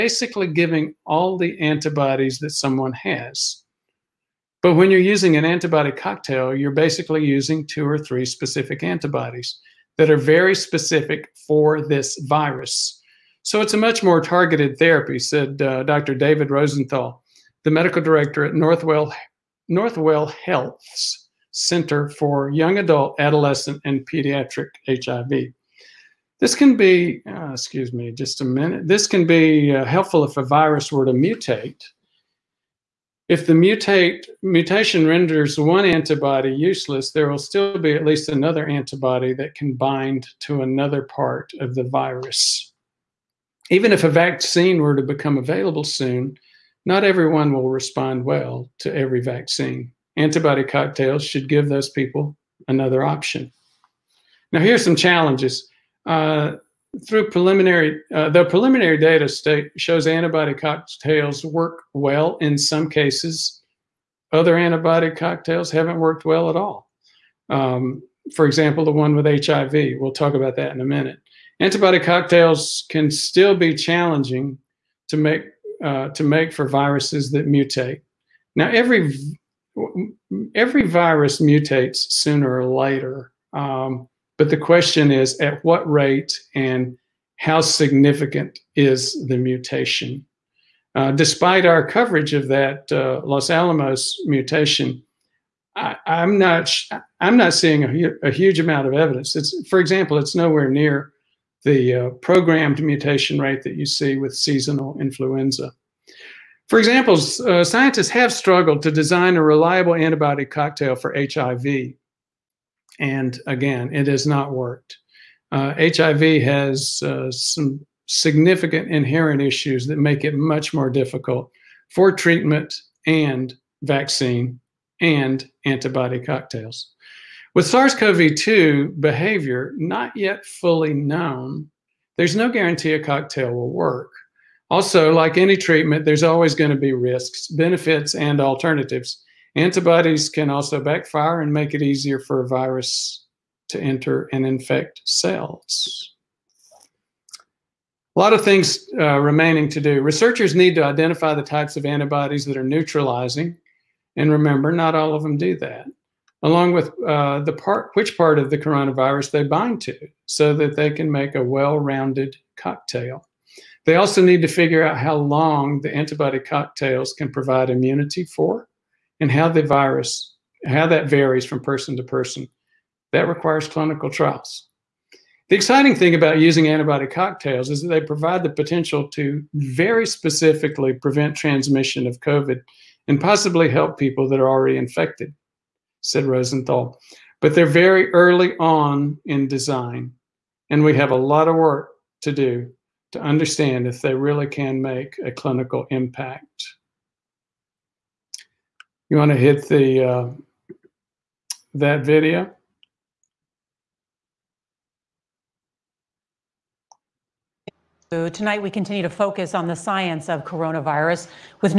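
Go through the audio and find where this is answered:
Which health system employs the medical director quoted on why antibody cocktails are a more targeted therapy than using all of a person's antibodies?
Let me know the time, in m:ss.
0:19.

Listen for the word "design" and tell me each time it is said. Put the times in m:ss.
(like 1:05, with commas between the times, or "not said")
1:48, 3:09.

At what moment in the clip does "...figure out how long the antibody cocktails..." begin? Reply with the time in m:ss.
2:44.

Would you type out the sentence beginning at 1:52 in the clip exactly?
And again, it has not worked.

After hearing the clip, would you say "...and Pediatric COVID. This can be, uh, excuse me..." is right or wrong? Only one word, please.
wrong.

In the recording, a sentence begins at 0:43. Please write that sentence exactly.
Even if a vaccine were to become available soon, not everyone will respond well to every vaccine.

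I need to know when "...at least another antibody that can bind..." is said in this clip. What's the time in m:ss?
0:37.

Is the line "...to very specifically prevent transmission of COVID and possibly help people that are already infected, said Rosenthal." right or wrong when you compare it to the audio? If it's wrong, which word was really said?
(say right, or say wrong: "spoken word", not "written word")
right.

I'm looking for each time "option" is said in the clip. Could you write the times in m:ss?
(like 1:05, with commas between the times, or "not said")
0:53.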